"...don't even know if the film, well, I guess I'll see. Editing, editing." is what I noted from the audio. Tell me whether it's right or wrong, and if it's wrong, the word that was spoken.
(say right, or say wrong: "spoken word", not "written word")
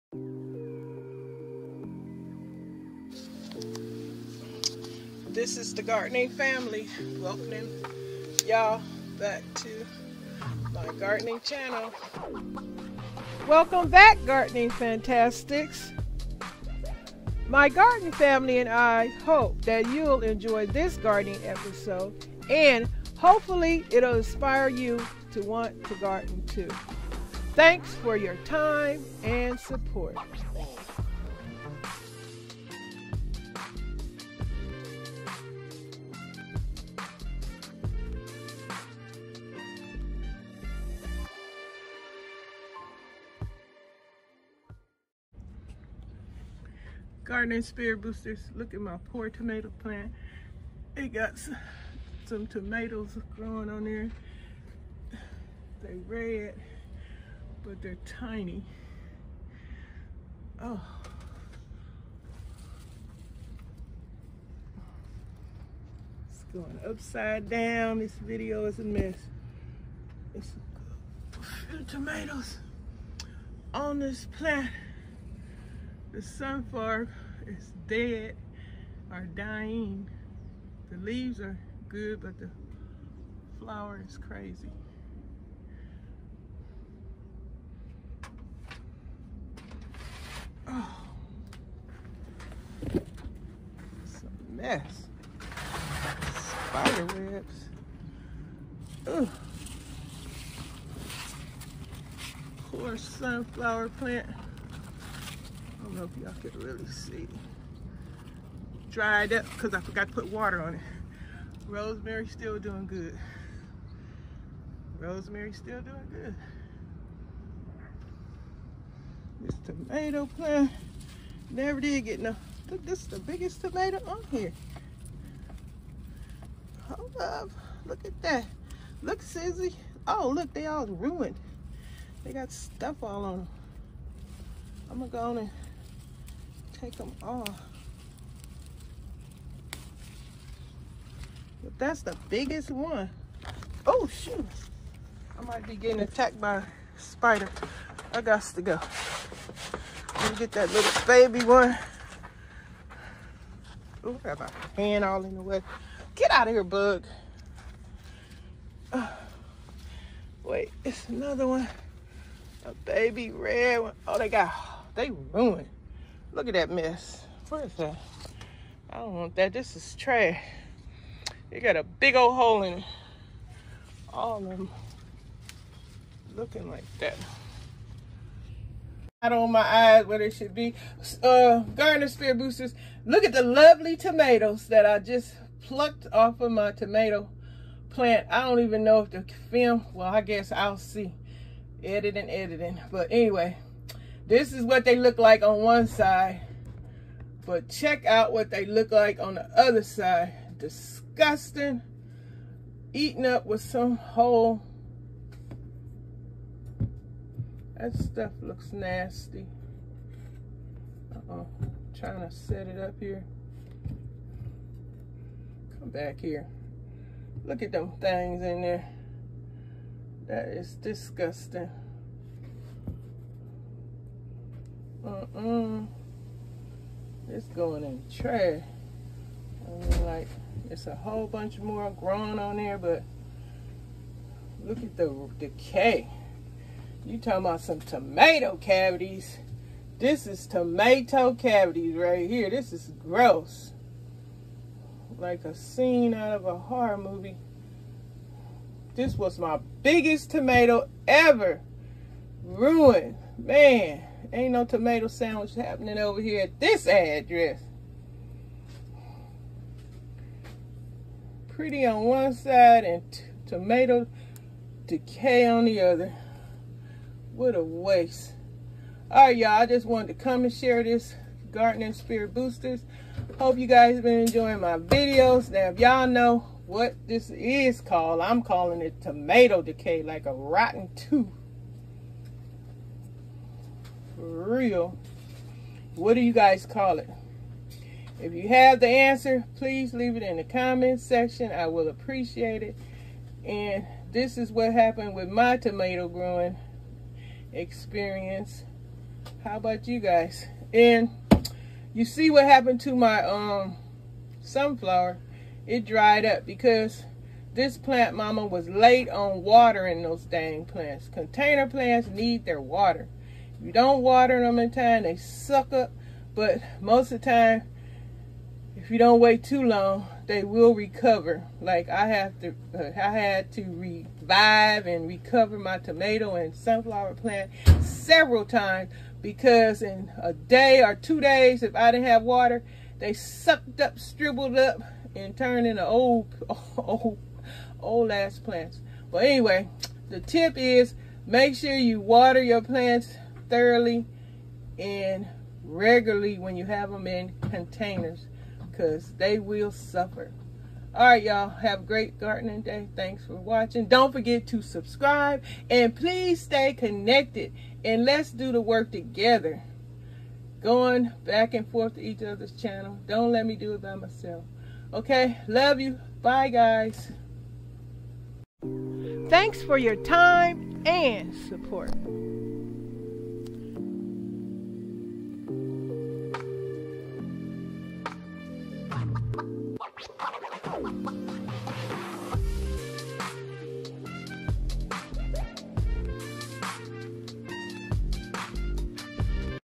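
right.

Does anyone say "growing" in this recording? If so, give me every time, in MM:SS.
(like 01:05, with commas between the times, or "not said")
00:53, 03:51, 04:56.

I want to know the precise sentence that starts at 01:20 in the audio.
The leaves are good, but the flower is crazy.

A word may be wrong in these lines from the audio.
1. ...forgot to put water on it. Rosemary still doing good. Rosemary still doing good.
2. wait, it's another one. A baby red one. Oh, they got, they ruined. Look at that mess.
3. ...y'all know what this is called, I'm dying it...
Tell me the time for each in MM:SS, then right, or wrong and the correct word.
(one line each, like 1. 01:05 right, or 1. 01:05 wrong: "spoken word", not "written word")
1. 01:49 right
2. 02:40 right
3. 04:35 wrong: "calling", not "dying".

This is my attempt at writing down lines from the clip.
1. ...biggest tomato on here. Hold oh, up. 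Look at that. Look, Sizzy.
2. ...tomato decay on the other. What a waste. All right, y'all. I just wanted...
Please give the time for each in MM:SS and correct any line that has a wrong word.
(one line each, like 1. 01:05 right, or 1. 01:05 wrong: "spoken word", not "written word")
1. 02:03 right
2. 04:23 right.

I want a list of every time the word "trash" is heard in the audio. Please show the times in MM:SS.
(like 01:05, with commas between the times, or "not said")
02:49, 03:48.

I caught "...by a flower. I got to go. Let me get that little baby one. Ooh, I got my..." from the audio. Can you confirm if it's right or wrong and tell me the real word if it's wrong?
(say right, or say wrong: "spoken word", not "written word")
wrong: "spider", not "flower".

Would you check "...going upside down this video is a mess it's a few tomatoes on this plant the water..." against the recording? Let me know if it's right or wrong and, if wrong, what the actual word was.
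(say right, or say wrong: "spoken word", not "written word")
wrong: "sunflower", not "water".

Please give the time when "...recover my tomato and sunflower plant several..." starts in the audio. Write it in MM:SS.
05:25.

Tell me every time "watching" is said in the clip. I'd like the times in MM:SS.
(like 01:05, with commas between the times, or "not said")
05:53.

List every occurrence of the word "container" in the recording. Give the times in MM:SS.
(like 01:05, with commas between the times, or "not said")
05:11, 05:47.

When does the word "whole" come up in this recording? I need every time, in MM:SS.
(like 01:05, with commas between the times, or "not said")
03:23, 03:50.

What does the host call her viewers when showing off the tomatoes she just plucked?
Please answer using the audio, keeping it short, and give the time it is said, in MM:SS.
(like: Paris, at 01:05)
Gardener Spirit Boosters, at 03:01.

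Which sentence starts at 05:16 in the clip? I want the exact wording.
But most of the time, if you don't wait too long, they will recover.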